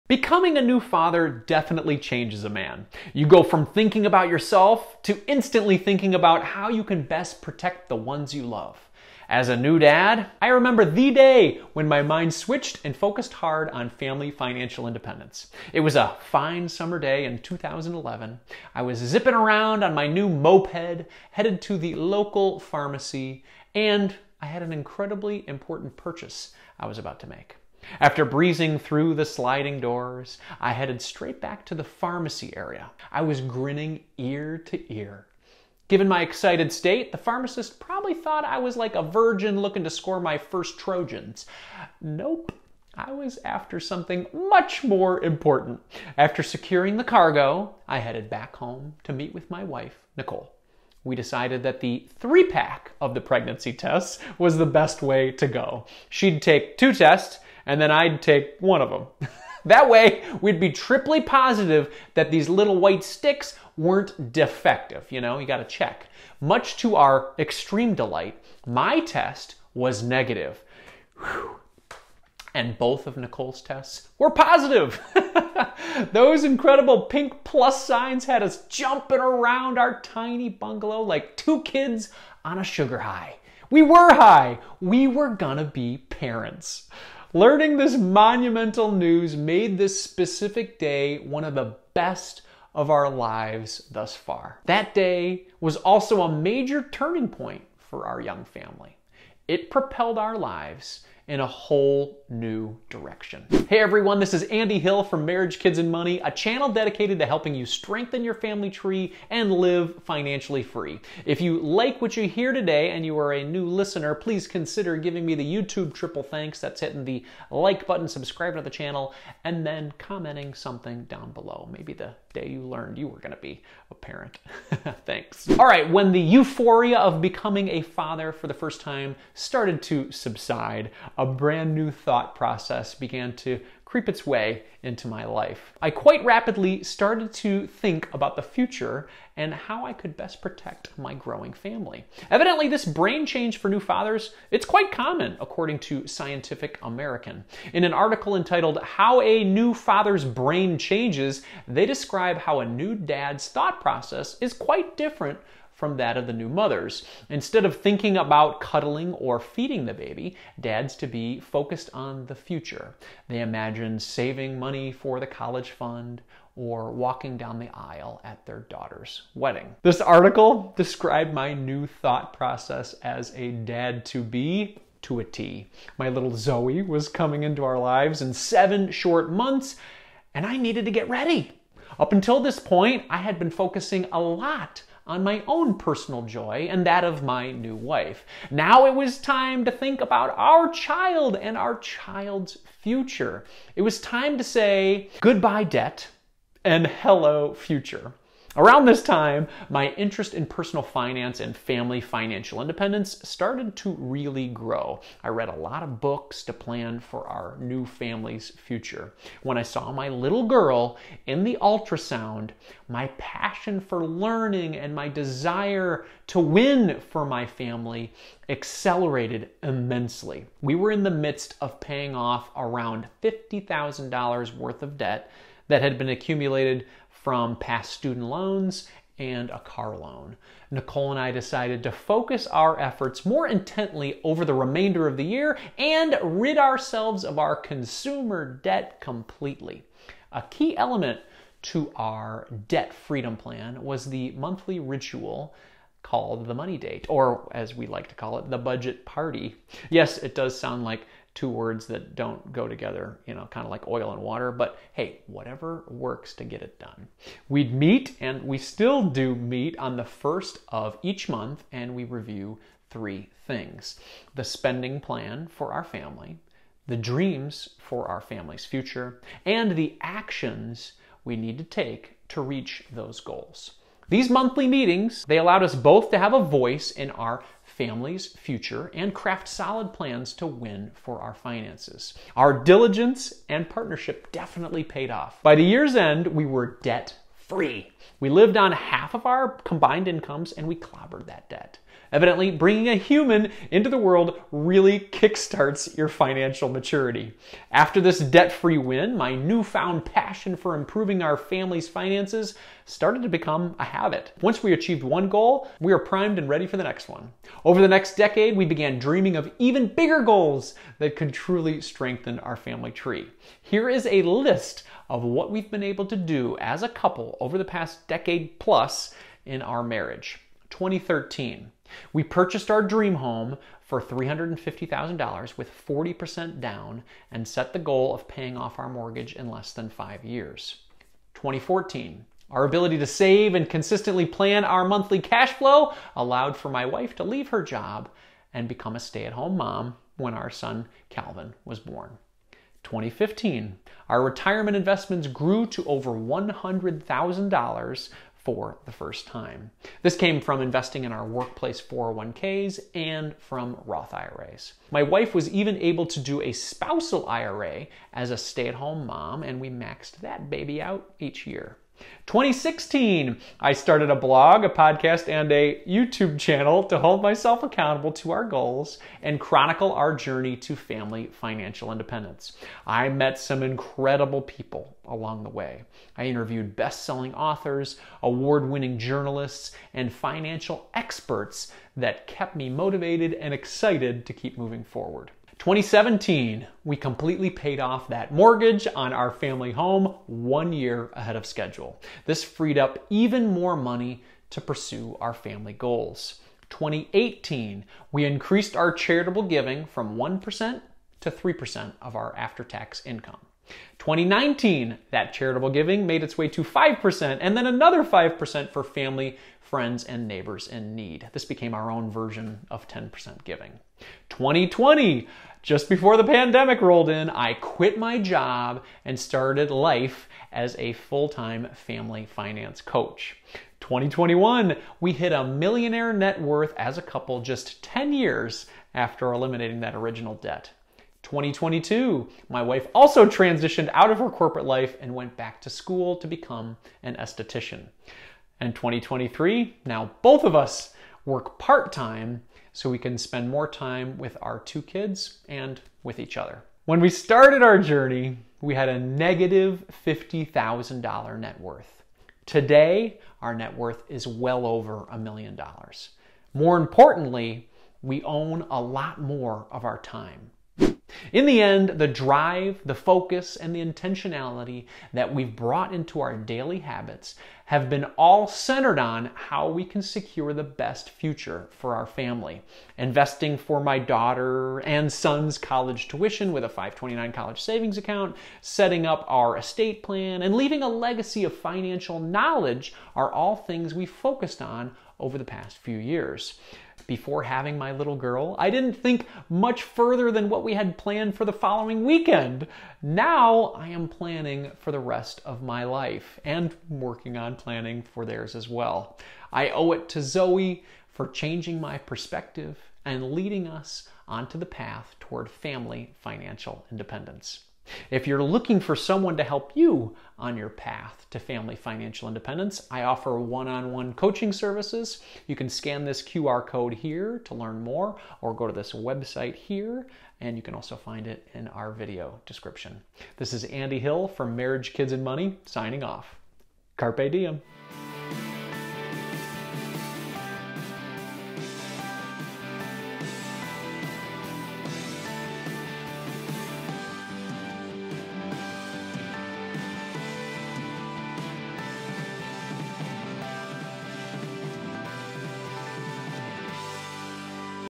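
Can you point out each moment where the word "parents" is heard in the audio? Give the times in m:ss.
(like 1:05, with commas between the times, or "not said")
1:26, 2:03.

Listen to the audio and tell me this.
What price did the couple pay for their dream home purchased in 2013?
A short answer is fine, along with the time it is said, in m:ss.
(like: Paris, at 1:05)
$350,000, at 5:24.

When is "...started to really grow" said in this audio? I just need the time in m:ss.
3:23.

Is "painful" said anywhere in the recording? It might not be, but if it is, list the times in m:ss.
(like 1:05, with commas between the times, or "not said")
not said.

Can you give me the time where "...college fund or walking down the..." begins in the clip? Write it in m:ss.
2:45.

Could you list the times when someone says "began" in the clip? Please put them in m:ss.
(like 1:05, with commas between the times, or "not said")
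2:12, 5:08.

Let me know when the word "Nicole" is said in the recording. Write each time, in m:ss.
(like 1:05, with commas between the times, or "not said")
0:50, 1:13, 3:50.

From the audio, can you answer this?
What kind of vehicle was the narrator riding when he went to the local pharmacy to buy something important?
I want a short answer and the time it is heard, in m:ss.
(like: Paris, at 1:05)
moped, at 0:20.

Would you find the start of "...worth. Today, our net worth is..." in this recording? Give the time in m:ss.
7:31.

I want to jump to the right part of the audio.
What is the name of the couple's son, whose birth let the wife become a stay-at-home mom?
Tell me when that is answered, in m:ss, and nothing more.
5:41.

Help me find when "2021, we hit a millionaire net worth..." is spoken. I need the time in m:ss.
7:03.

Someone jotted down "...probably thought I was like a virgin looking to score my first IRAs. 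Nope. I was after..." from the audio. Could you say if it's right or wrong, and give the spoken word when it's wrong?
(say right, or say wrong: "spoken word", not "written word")
wrong: "Trojans", not "IRAs".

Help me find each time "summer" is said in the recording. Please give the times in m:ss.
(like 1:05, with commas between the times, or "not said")
0:16.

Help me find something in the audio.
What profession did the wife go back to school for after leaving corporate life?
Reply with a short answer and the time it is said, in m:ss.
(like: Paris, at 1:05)
esthetician, at 7:17.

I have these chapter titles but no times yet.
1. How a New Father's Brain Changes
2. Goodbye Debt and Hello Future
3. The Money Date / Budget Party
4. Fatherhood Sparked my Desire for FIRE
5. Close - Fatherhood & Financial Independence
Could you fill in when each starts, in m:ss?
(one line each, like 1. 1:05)
1. 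2:30
2. 3:17
3. 4:07
4. 5:21
5. 8:47.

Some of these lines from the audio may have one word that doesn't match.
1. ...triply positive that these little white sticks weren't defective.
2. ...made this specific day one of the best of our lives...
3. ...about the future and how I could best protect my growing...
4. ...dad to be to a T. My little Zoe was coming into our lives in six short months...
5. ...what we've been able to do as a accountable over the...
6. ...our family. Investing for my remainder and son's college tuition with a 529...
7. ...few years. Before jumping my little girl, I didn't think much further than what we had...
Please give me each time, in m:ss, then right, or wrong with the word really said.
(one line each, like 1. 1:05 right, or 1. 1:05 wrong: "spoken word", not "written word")
1. 1:00 right
2. 1:29 right
3. 2:18 right
4. 2:53 wrong: "seven", not "six"
5. 5:15 wrong: "couple", not "accountable"
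6. 7:51 wrong: "daughter", not "remainder"
7. 8:05 wrong: "having", not "jumping".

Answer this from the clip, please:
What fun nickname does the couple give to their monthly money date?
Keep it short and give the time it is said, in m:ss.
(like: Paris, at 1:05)
budget party, at 4:08.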